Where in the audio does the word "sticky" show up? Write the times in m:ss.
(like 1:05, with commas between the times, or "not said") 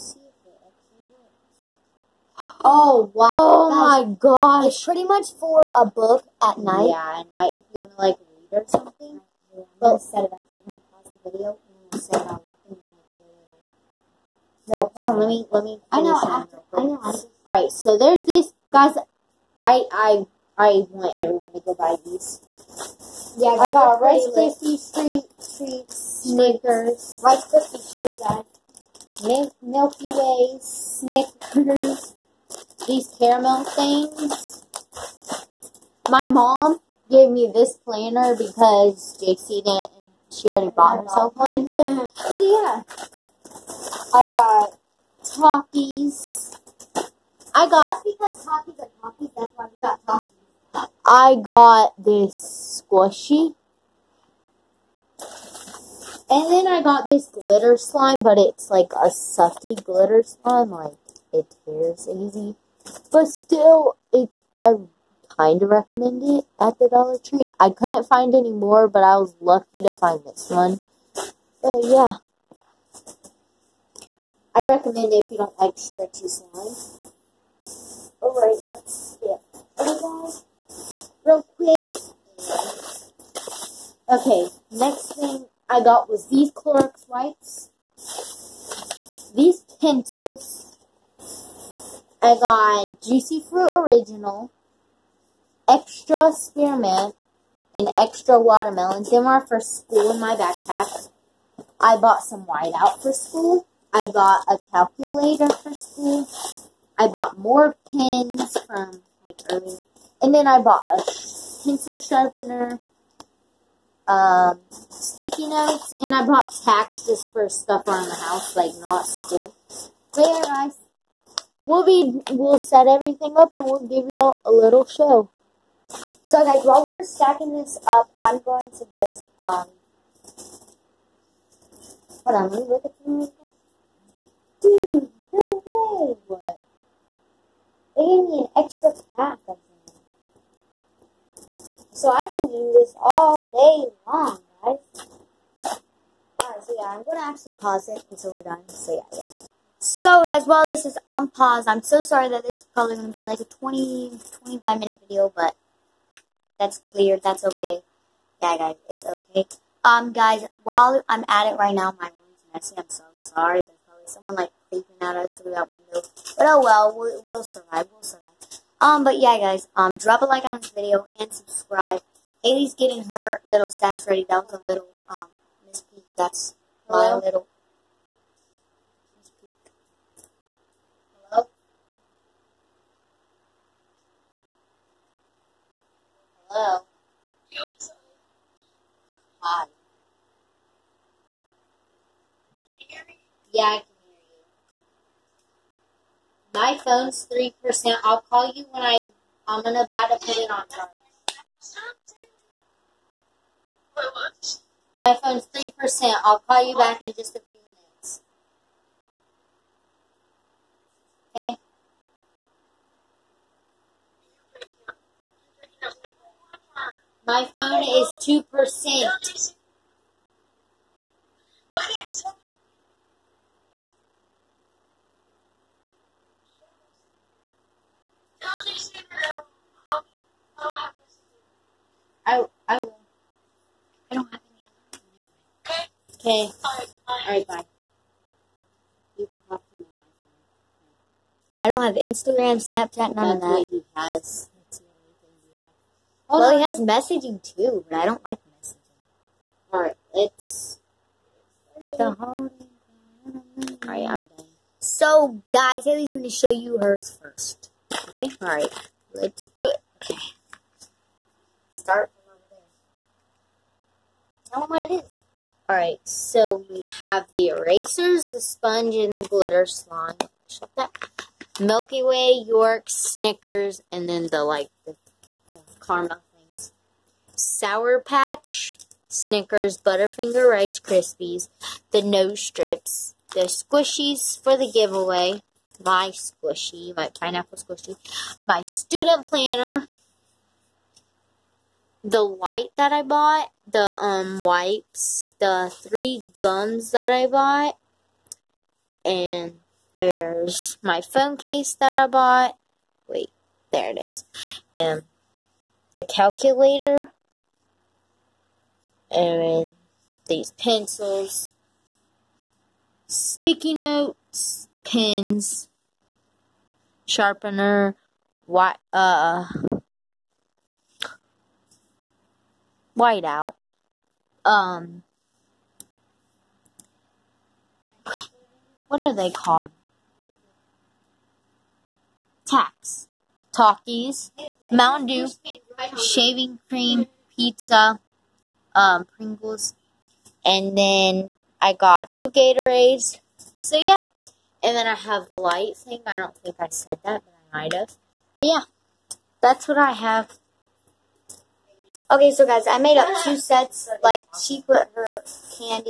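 1:54, 5:13.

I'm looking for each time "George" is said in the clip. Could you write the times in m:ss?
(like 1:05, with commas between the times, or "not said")
not said.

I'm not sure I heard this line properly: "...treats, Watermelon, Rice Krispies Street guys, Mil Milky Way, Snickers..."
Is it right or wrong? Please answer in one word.
wrong.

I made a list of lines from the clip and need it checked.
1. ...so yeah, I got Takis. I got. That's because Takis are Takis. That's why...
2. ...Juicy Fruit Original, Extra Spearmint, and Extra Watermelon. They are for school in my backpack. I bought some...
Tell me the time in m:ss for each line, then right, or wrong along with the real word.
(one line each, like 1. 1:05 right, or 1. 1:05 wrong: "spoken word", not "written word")
1. 0:41 right
2. 1:33 right.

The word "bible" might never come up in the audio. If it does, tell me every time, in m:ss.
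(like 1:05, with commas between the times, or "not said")
not said.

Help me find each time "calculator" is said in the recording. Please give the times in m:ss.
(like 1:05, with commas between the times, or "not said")
1:44, 5:06.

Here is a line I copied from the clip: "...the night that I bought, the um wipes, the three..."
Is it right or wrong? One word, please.
wrong.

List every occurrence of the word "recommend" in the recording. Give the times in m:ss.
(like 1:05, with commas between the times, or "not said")
1:05, 1:14.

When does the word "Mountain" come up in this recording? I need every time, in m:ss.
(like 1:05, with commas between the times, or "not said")
5:34.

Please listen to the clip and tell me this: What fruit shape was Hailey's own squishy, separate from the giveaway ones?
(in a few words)
Pineapple.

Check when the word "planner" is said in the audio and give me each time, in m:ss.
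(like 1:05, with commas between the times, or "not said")
0:37, 4:49.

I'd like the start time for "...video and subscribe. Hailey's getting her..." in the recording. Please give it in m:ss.
2:50.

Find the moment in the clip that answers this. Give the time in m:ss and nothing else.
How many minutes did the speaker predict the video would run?
2:33.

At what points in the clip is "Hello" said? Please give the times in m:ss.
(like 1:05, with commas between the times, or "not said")
2:56, 3:01, 3:06.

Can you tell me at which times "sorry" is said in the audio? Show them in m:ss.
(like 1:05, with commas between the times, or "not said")
2:32, 2:43.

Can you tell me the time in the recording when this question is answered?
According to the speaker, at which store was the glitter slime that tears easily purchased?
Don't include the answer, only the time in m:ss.
1:06.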